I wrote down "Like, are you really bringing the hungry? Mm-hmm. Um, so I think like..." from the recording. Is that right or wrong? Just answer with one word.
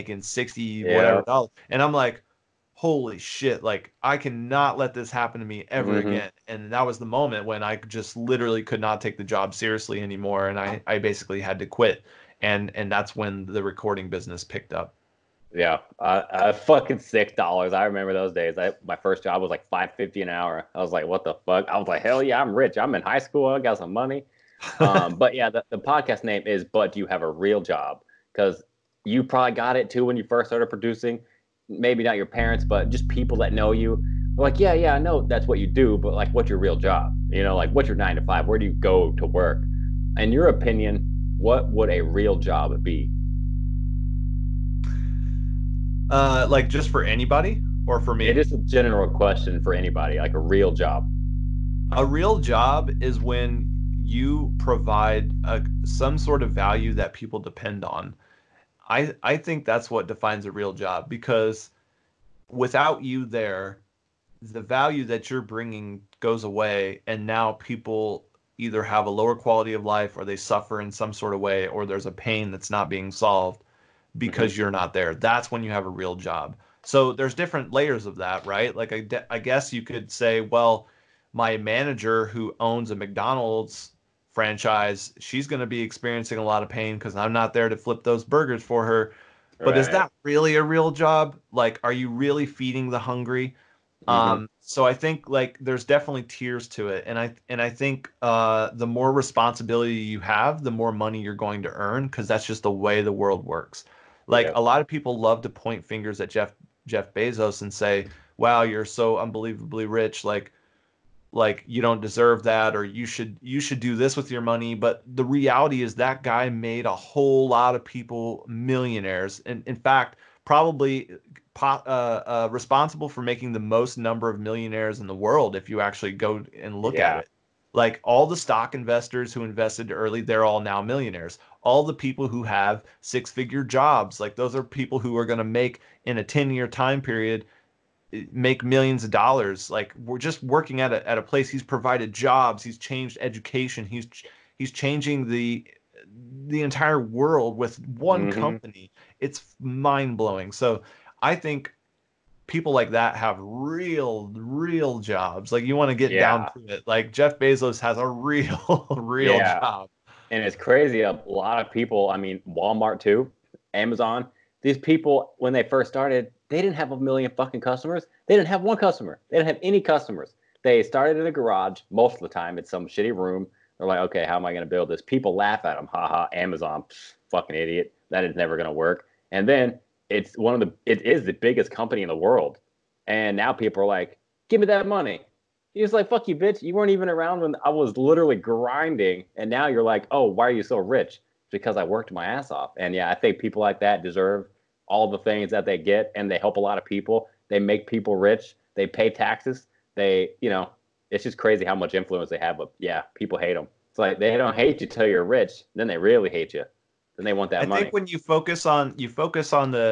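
wrong.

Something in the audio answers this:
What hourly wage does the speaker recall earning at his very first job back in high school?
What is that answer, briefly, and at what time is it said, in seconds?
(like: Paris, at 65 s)
$5.50, at 19 s.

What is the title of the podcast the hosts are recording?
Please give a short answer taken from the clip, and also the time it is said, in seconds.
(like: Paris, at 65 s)
But Do You Have a Real Job?, at 26 s.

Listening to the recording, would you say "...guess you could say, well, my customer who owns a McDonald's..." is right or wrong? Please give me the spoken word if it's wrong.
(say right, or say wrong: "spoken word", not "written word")
wrong: "manager", not "customer".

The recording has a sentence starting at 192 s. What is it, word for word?
And yeah, I think people like that deserve all the things that they get and they help a lot of people.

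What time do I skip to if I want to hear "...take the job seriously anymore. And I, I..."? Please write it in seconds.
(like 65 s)
8 s.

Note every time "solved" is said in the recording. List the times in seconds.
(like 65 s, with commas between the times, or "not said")
73 s.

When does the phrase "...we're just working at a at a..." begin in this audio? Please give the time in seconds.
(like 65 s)
140 s.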